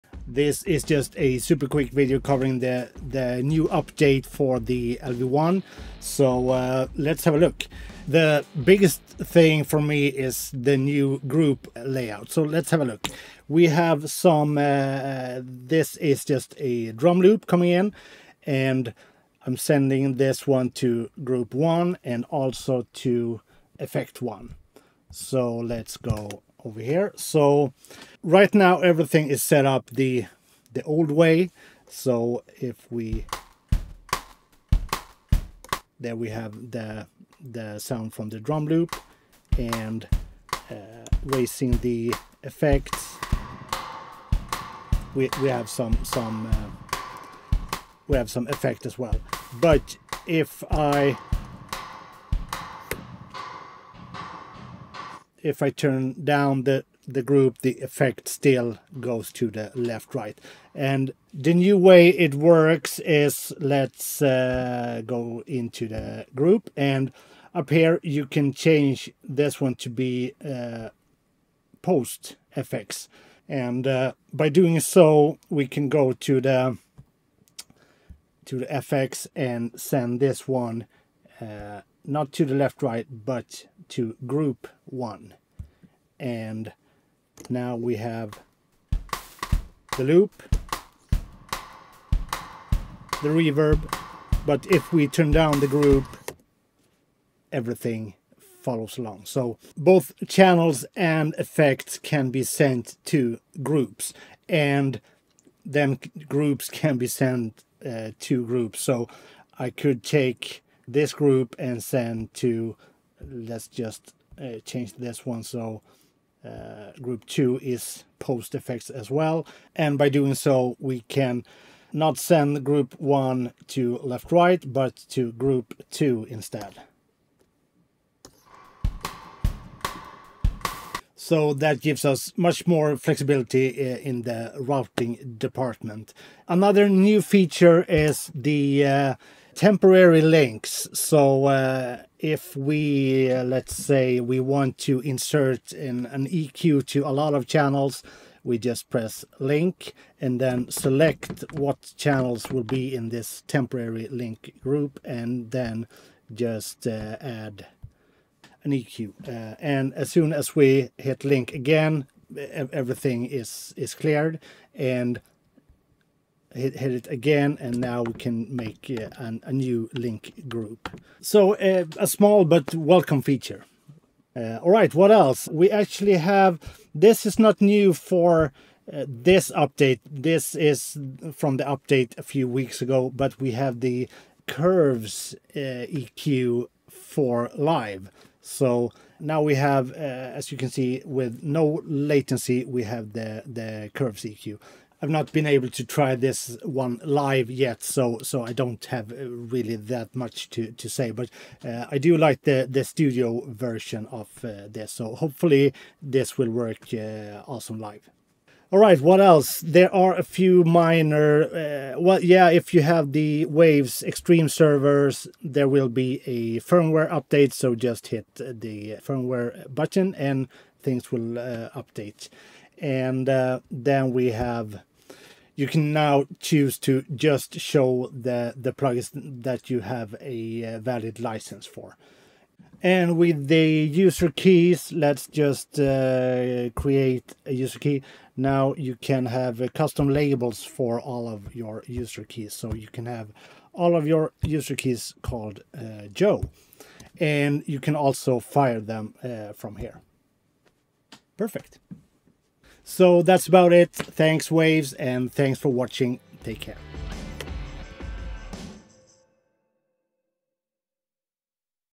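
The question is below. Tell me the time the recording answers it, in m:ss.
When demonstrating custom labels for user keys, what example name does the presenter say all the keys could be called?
4:06.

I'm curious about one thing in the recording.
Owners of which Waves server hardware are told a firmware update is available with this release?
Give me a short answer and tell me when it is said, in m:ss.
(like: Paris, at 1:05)
Waves Extreme servers, at 3:33.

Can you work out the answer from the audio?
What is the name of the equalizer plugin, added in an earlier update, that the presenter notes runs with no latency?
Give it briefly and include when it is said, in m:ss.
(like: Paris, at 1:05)
Curves EQ, at 3:04.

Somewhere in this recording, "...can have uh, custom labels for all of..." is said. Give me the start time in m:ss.
3:58.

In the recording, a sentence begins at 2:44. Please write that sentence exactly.
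And hit, hit it again and now we can make uh, an, a new link group.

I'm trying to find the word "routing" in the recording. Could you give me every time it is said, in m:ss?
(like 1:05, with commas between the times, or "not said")
2:14.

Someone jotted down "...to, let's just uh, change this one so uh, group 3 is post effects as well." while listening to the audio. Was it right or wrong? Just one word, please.
wrong.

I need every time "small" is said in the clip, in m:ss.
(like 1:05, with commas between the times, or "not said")
2:52.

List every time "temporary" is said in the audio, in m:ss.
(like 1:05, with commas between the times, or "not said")
2:19, 2:33.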